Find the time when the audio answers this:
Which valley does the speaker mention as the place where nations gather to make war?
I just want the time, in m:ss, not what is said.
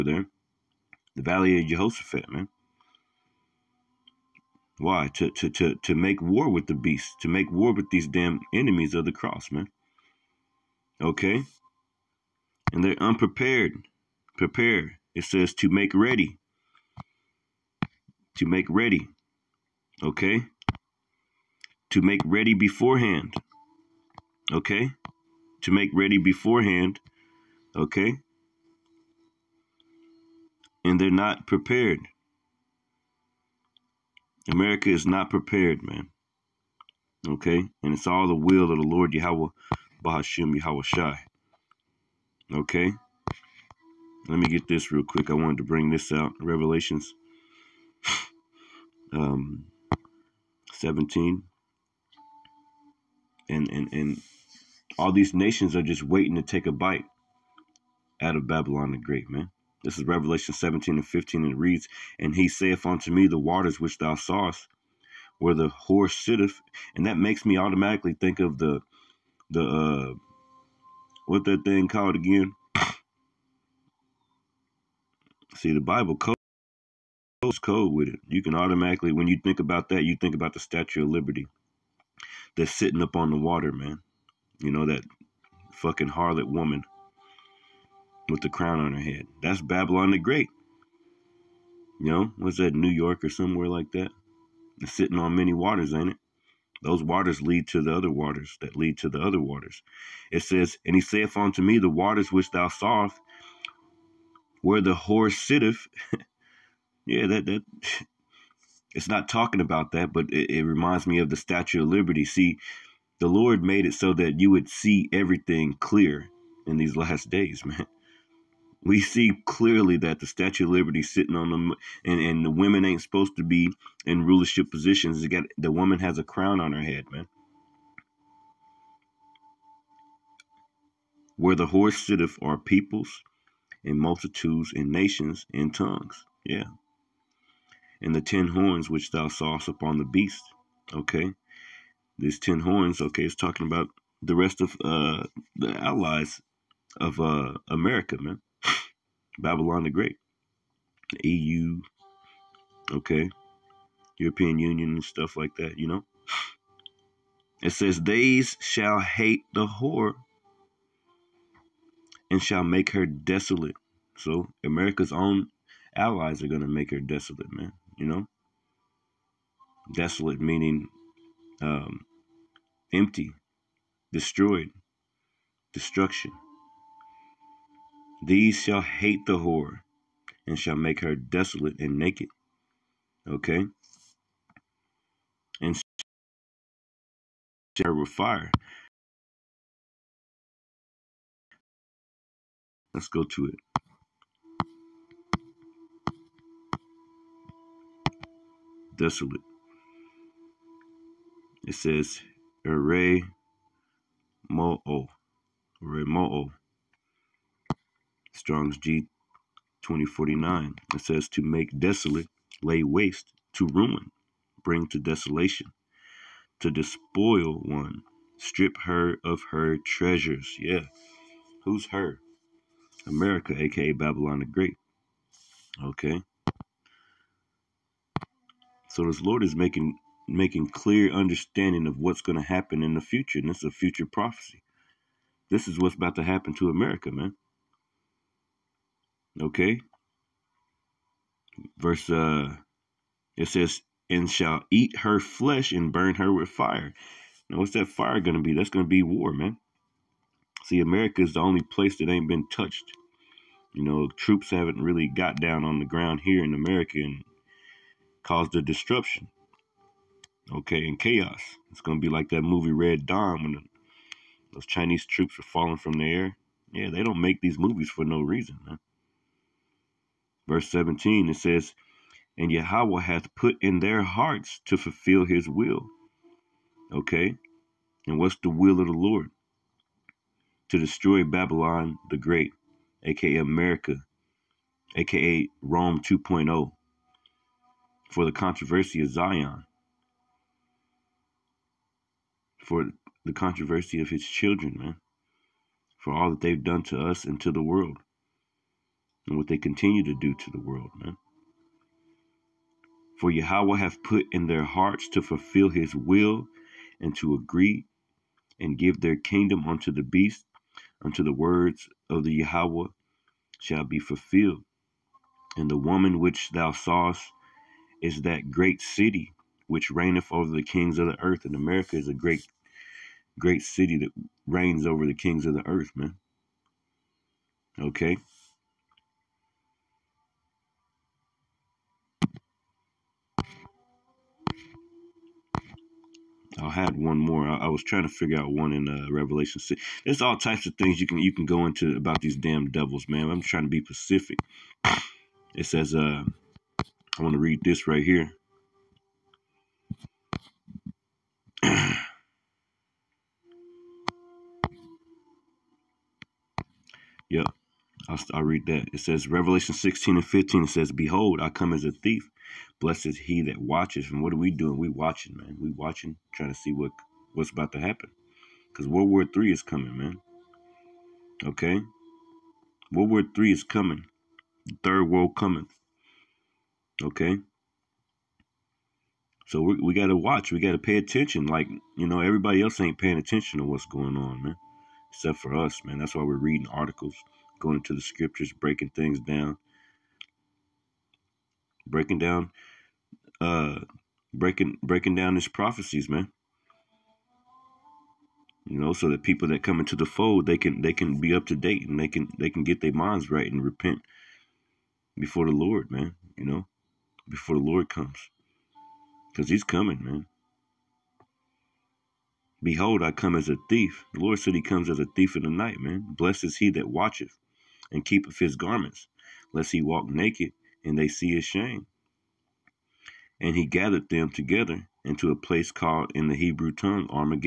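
0:01.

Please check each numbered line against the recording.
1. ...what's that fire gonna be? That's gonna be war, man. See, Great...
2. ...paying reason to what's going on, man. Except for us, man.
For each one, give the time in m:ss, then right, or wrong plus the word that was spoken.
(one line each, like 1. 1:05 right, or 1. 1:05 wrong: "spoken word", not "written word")
1. 4:07 wrong: "America", not "Great"
2. 6:22 wrong: "attention", not "reason".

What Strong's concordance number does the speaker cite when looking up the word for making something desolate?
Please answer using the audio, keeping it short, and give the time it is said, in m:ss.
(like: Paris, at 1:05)
G 2049, at 3:28.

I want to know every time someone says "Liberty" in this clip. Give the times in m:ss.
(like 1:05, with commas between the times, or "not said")
1:21, 1:51, 2:00.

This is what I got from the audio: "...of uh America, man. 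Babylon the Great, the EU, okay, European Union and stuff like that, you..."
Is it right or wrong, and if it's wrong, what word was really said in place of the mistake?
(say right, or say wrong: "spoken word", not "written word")
right.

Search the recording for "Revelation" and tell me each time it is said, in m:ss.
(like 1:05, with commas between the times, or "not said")
0:46, 1:00, 5:39, 5:59.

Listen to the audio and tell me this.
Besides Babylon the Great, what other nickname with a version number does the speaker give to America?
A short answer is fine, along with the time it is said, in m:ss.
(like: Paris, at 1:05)
Rome 2.0, at 4:45.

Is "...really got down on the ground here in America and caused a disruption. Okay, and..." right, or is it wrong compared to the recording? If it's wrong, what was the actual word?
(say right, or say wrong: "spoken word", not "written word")
right.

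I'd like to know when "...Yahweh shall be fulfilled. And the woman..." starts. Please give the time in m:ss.
5:12.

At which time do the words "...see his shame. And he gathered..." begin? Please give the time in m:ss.
7:01.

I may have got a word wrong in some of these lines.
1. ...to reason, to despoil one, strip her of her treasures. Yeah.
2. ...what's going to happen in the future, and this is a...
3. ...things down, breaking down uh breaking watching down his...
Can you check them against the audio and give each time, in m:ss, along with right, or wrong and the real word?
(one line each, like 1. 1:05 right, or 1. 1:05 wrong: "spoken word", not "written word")
1. 3:34 wrong: "desolation", not "reason"
2. 3:51 right
3. 6:28 wrong: "breaking", not "watching".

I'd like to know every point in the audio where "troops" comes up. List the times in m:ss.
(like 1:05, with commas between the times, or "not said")
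4:14, 4:25.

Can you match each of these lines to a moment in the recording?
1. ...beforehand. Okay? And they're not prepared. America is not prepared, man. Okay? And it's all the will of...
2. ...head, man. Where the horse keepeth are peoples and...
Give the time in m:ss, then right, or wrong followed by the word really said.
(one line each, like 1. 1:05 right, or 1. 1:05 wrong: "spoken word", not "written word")
1. 0:26 right
2. 2:06 wrong: "sitteth", not "keepeth".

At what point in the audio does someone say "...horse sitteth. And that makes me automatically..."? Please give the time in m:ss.
1:05.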